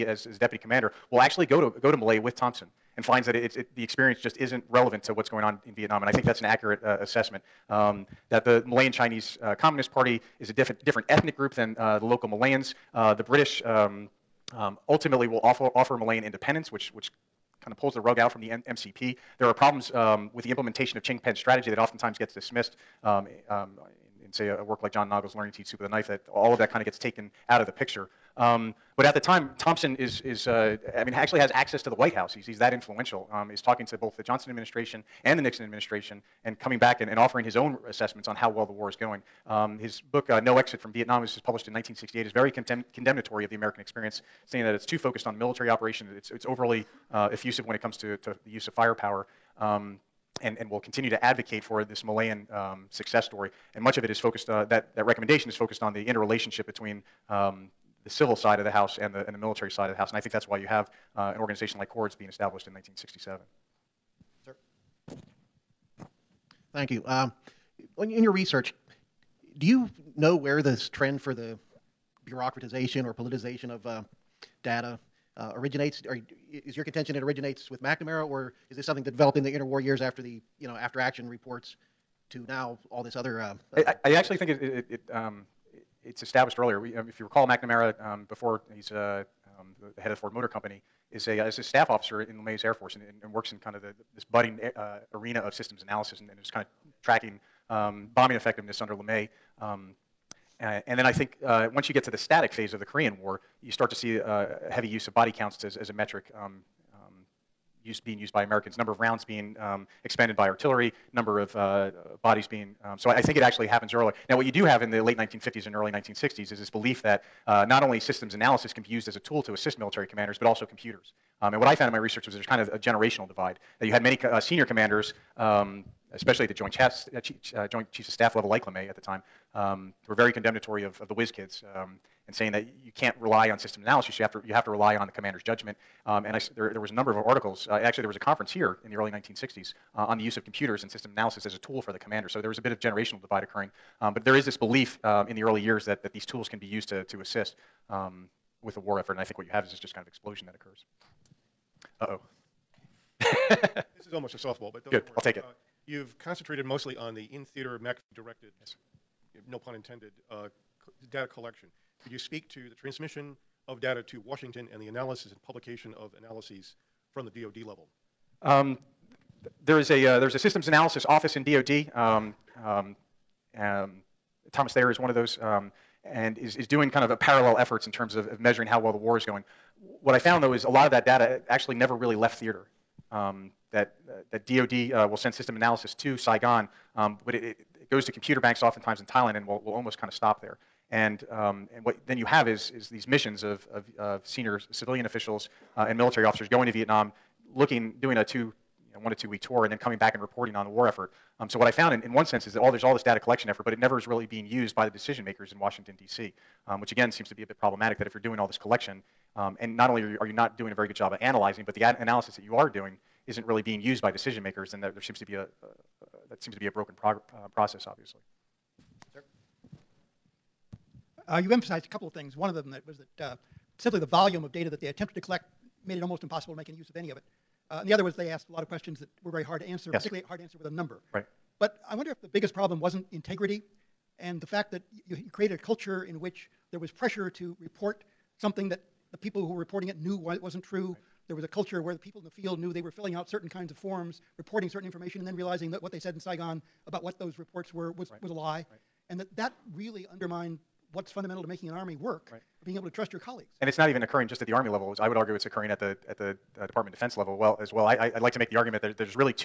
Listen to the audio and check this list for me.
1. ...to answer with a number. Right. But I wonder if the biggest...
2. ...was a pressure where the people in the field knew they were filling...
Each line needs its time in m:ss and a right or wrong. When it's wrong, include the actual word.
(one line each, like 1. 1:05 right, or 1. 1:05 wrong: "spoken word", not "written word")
1. 3:50 right
2. 4:01 wrong: "culture", not "pressure".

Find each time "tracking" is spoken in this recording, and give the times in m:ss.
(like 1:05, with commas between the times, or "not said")
1:37.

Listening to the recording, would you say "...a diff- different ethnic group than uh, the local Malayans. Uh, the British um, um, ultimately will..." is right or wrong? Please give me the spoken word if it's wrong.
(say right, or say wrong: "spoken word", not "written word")
right.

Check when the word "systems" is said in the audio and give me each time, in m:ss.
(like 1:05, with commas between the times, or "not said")
1:35, 1:57, 2:13, 2:20, 2:50, 3:05.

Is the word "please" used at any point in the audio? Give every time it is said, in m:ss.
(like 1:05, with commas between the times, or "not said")
not said.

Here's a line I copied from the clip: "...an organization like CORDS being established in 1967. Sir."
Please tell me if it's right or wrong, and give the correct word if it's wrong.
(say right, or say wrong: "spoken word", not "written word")
right.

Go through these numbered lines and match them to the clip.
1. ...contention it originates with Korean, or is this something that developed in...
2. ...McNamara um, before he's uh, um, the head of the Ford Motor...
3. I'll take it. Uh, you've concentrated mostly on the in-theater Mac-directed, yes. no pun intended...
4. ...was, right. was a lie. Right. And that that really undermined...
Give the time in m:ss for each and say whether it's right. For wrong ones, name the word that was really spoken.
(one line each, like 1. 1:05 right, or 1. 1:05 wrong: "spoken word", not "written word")
1. 1:16 wrong: "McNamara", not "Korean"
2. 1:27 right
3. 2:35 right
4. 4:07 right.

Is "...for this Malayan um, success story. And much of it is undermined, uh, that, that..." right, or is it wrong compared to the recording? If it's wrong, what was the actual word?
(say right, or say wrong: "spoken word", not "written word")
wrong: "focused", not "undermined".